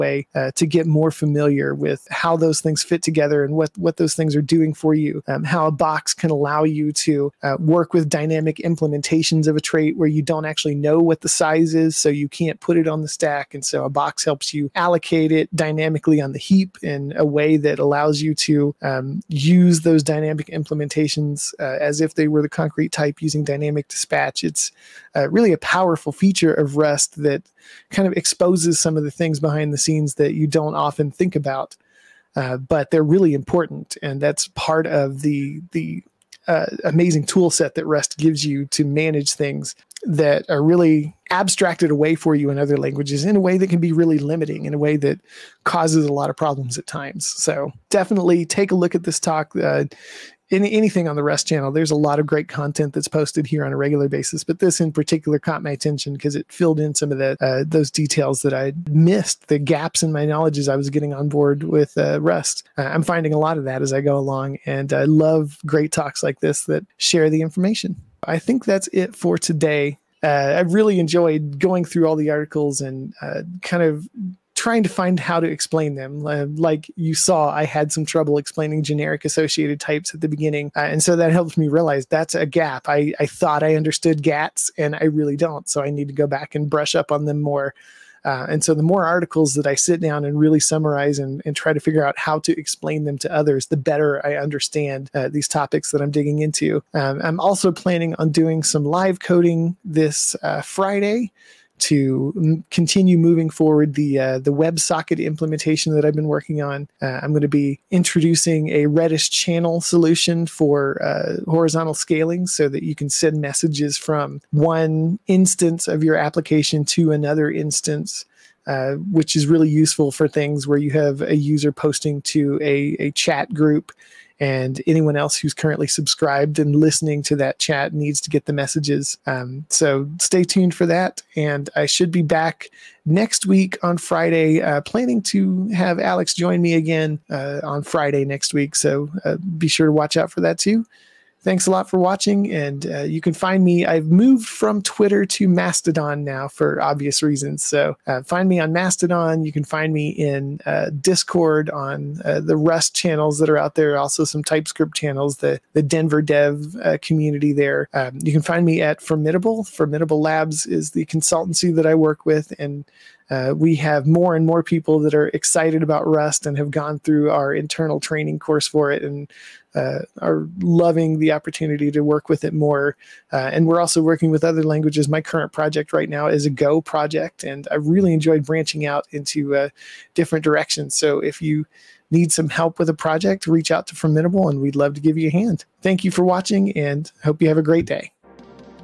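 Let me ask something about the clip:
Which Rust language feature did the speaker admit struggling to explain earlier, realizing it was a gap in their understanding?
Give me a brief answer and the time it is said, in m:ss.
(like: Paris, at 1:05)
generic associated types, at 1:18.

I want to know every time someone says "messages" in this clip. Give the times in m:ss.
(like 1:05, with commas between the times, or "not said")
1:53, 2:08.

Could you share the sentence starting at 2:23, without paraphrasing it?
I've moved from Twitter to Mastodon now for obvious reasons.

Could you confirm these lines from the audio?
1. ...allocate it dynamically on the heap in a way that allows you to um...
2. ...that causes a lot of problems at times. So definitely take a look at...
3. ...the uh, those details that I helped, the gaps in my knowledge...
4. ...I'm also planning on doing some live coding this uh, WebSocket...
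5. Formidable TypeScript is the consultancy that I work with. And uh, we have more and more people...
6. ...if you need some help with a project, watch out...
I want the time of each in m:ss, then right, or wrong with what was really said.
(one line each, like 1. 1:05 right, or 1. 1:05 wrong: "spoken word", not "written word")
1. 0:14 right
2. 0:44 right
3. 0:57 wrong: "missed", not "helped"
4. 1:37 wrong: "Friday", not "WebSocket"
5. 2:39 wrong: "Labs", not "TypeScript"
6. 3:01 wrong: "reach", not "watch".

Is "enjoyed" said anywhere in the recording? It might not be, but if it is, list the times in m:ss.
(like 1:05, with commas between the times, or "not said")
1:10, 2:58.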